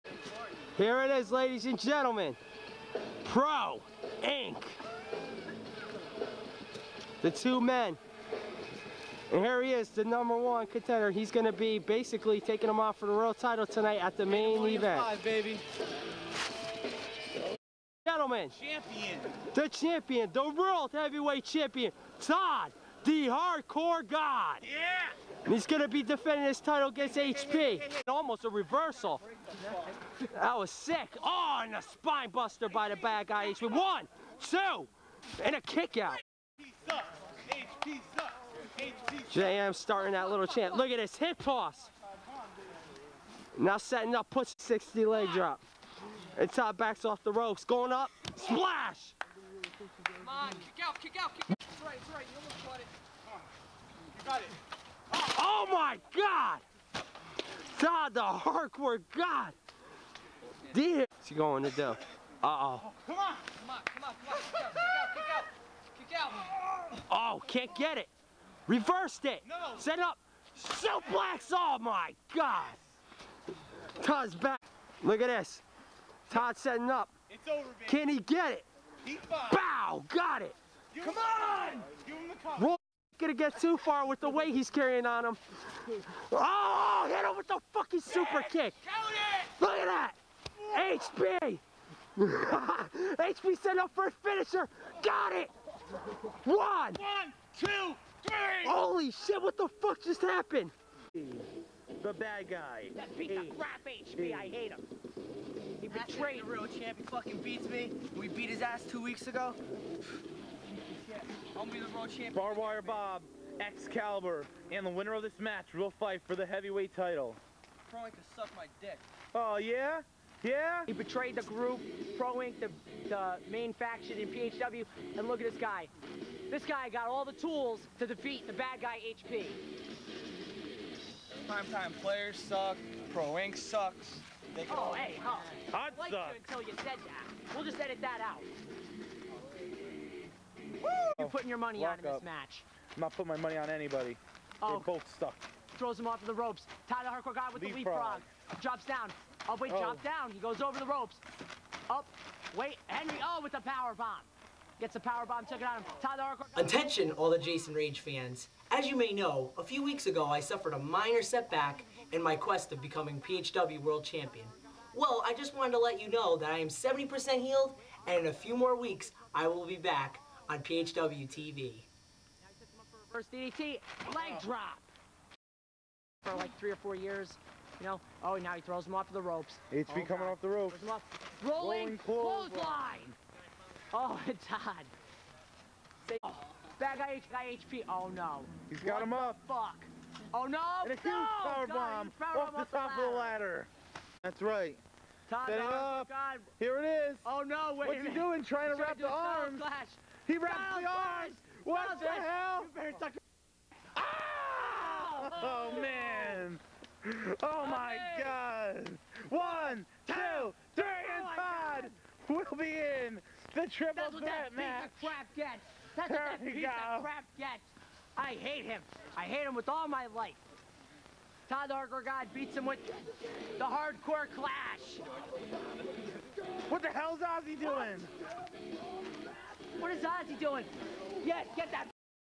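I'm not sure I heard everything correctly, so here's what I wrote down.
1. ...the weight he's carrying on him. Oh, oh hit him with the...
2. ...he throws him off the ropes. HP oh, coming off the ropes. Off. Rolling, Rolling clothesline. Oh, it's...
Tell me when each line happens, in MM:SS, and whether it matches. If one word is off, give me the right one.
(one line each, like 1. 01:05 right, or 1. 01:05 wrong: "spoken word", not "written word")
1. 01:24 right
2. 02:58 right.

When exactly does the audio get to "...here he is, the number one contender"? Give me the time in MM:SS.
00:09.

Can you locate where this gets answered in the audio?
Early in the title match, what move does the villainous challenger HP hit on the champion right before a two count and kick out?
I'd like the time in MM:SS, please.
00:31.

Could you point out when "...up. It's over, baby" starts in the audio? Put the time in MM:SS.
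01:16.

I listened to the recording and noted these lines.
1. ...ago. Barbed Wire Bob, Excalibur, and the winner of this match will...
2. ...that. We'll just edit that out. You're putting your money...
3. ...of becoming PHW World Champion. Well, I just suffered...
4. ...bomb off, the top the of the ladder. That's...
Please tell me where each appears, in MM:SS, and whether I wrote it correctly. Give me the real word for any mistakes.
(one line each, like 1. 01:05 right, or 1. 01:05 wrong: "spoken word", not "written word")
1. 01:49 right
2. 02:17 right
3. 02:42 wrong: "wanted", not "suffered"
4. 03:11 right.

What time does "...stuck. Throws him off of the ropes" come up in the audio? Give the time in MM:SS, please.
02:25.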